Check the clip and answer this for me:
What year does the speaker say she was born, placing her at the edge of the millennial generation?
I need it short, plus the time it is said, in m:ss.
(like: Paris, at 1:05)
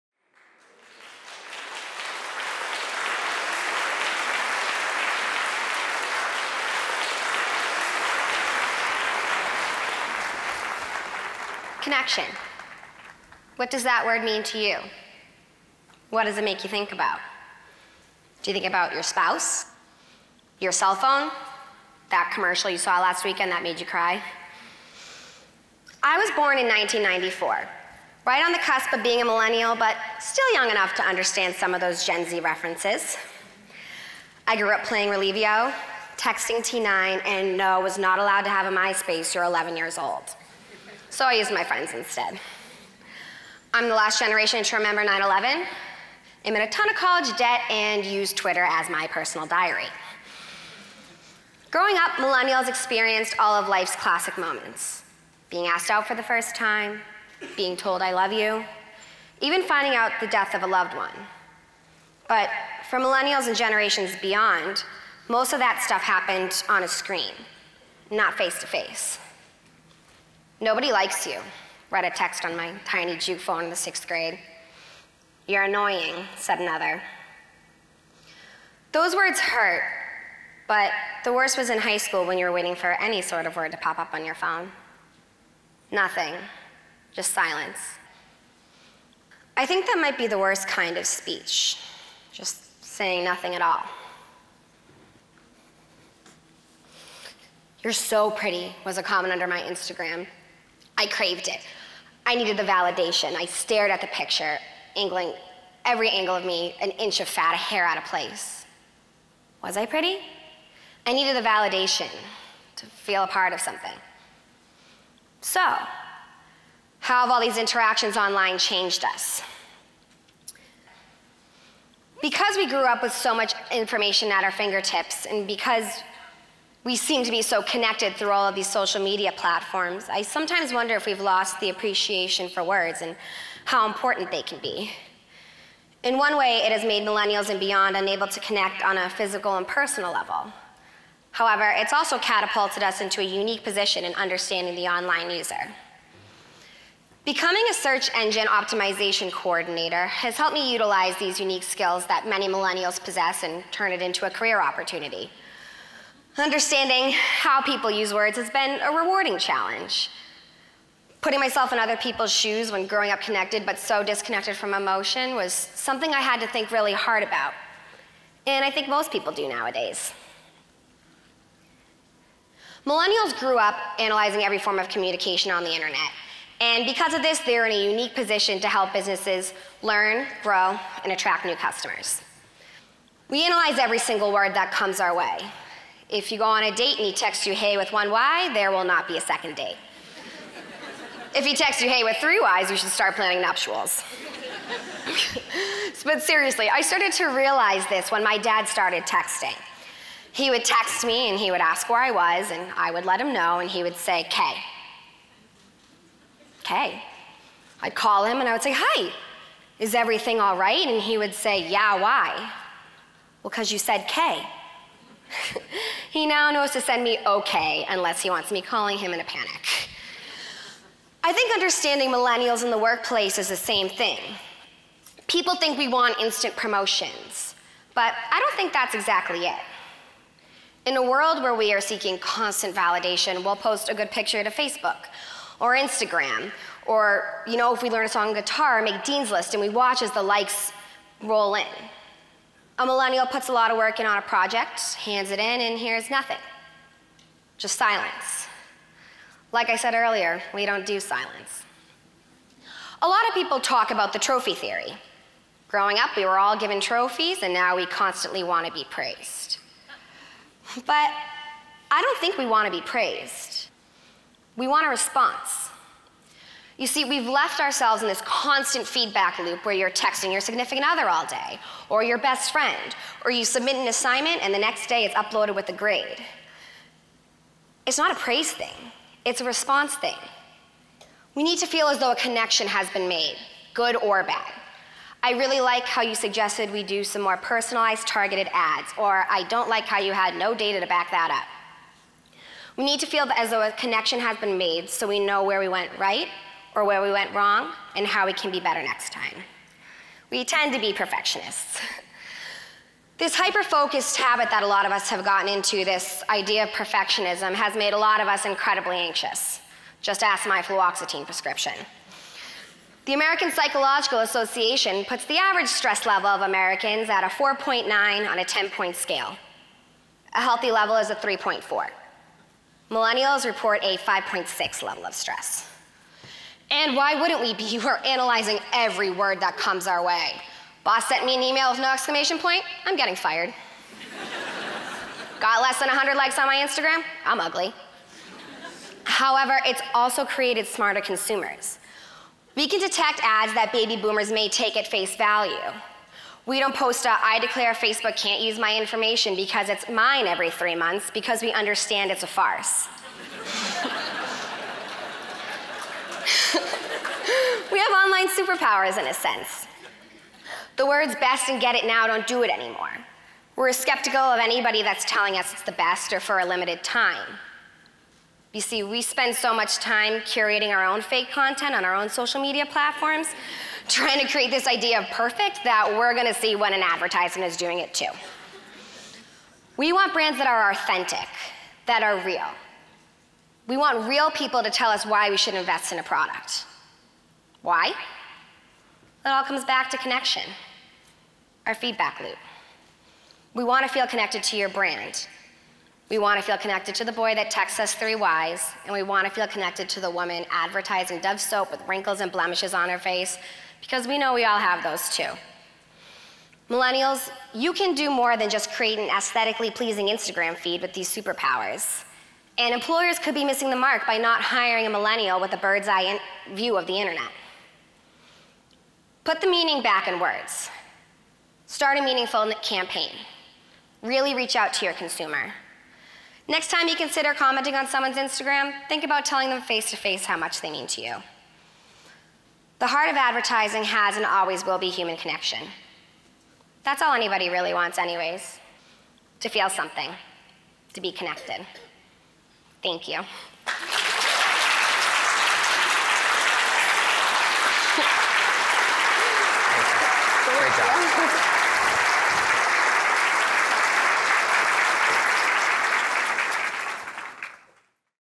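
1994, at 0:26.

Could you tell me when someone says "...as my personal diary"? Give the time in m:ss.
0:48.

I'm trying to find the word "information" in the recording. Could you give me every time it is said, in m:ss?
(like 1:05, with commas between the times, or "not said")
2:03, 5:48.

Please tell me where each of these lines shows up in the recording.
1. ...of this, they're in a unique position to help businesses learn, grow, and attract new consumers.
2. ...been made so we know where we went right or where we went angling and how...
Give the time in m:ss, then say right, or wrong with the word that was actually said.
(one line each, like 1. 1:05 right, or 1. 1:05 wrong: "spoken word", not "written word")
1. 2:57 wrong: "customers", not "consumers"
2. 4:54 wrong: "wrong", not "angling".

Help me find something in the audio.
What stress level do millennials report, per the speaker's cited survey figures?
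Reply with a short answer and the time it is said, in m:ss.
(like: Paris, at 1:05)
5.6, at 5:23.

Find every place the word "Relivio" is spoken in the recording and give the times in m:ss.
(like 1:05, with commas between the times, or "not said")
0:35.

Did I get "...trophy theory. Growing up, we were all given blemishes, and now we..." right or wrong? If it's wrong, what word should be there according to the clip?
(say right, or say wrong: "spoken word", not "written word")
wrong: "trophies", not "blemishes".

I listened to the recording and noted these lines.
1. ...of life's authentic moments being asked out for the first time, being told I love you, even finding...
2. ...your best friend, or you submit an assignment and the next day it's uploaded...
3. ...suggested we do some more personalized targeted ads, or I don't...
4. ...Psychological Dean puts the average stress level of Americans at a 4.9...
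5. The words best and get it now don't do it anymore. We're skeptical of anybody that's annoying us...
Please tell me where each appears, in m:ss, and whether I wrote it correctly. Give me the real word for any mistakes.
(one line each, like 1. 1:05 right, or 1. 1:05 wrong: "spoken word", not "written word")
1. 0:53 wrong: "classic", not "authentic"
2. 4:32 right
3. 4:46 right
4. 5:13 wrong: "Association", not "Dean"
5. 6:00 wrong: "telling", not "annoying".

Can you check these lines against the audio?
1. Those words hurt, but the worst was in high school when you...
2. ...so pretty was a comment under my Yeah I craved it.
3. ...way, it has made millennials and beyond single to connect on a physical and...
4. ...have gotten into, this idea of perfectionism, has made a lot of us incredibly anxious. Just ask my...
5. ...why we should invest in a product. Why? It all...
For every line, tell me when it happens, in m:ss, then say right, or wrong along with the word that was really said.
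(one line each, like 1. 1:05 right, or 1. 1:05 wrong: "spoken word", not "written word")
1. 1:18 right
2. 1:37 wrong: "Instagram", not "Yeah"
3. 2:16 wrong: "unable", not "single"
4. 5:05 right
5. 6:25 right.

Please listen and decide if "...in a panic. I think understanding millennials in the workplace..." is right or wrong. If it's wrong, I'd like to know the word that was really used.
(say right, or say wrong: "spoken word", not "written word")
right.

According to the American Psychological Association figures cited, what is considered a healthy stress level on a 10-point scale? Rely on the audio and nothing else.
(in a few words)
3.4.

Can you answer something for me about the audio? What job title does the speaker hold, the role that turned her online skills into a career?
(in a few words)
Search engine optimization coordinator.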